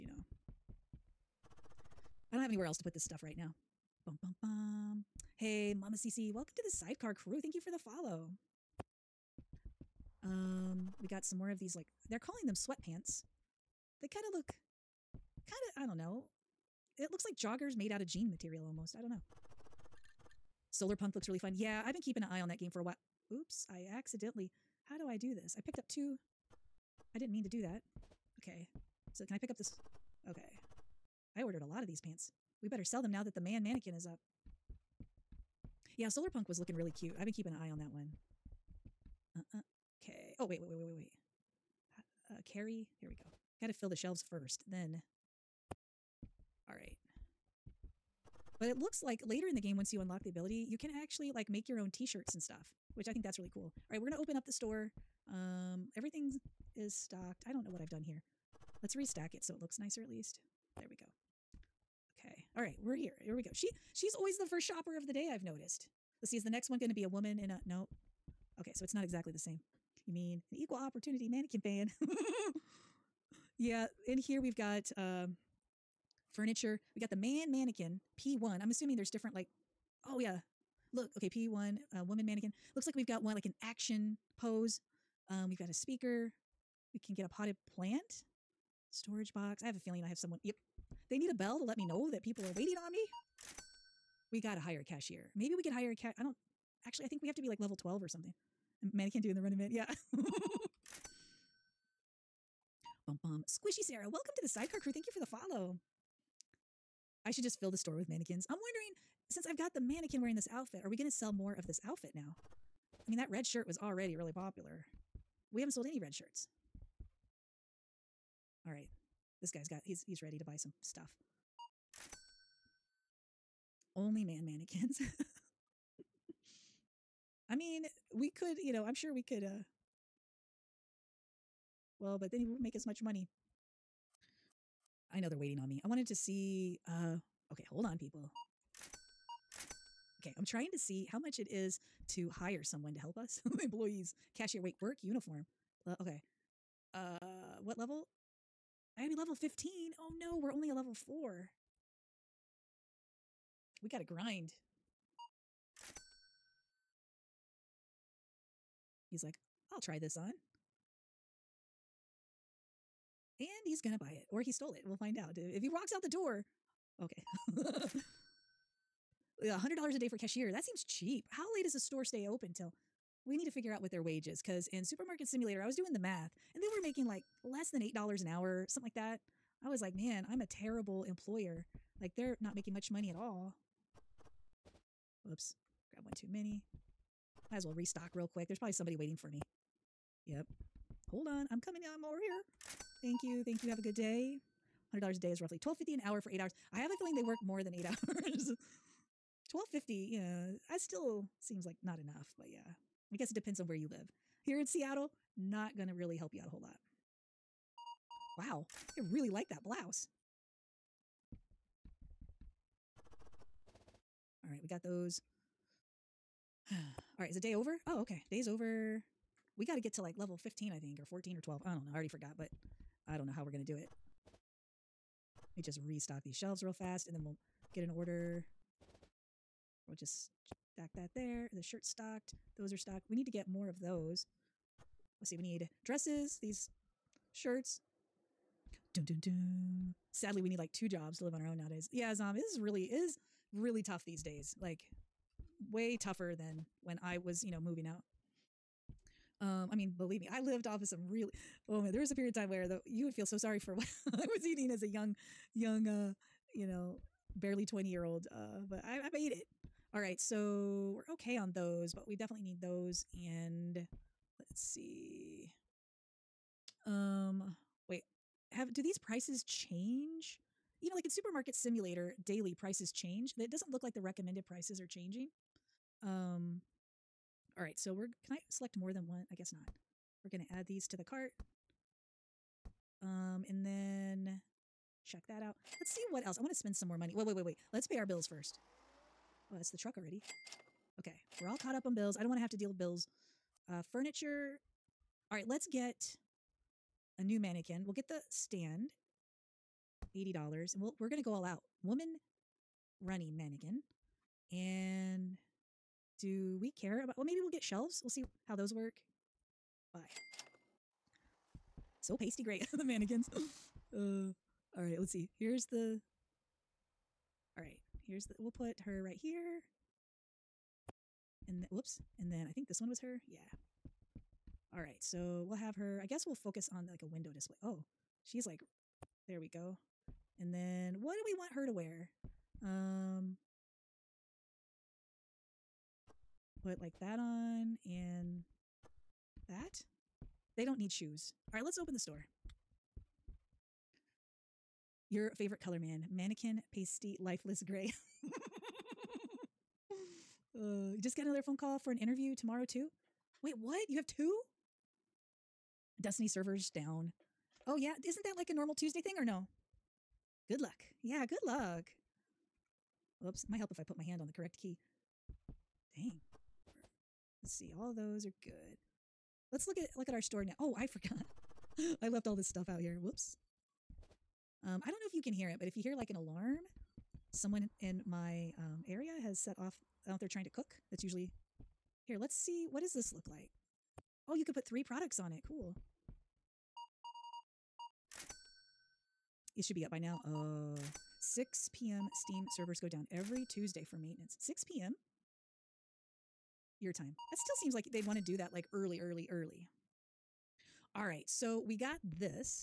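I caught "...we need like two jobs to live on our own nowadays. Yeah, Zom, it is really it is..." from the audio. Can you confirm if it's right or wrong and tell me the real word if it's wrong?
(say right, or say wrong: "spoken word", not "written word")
right.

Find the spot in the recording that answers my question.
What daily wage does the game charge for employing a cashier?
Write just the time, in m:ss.
2:49.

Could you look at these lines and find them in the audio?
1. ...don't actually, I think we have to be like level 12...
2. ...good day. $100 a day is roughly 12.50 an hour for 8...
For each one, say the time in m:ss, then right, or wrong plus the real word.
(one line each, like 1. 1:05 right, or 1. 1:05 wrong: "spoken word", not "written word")
1. 1:36 right
2. 3:13 right.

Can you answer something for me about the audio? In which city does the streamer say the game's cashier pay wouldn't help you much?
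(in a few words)
Seattle.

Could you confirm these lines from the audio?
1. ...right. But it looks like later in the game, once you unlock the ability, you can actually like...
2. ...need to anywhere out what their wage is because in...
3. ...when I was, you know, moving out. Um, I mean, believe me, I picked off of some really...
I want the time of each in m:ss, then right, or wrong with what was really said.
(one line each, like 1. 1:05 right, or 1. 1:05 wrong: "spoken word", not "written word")
1. 0:46 right
2. 2:53 wrong: "figure", not "anywhere"
3. 4:06 wrong: "lived", not "picked".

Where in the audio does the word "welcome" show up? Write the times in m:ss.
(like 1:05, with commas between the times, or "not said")
0:06, 1:44.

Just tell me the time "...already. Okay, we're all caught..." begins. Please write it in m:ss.
4:49.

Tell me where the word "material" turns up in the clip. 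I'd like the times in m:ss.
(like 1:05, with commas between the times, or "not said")
0:18.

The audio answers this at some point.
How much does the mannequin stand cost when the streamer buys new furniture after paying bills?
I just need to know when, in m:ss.
5:00.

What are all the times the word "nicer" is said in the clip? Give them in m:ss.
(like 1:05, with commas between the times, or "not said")
0:59.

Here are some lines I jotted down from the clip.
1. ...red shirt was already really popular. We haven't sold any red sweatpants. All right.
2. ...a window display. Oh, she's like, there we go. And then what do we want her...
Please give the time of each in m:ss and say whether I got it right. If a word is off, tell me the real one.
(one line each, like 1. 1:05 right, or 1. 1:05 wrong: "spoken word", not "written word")
1. 1:53 wrong: "shirts", not "sweatpants"
2. 5:27 right.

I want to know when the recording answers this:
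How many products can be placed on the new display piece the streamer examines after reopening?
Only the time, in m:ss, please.
6:24.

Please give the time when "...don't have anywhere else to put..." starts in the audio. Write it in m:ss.
0:02.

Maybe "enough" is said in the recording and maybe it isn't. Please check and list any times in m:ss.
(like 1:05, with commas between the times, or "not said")
3:21.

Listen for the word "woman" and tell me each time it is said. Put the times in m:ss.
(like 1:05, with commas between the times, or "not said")
1:07, 1:22, 5:01.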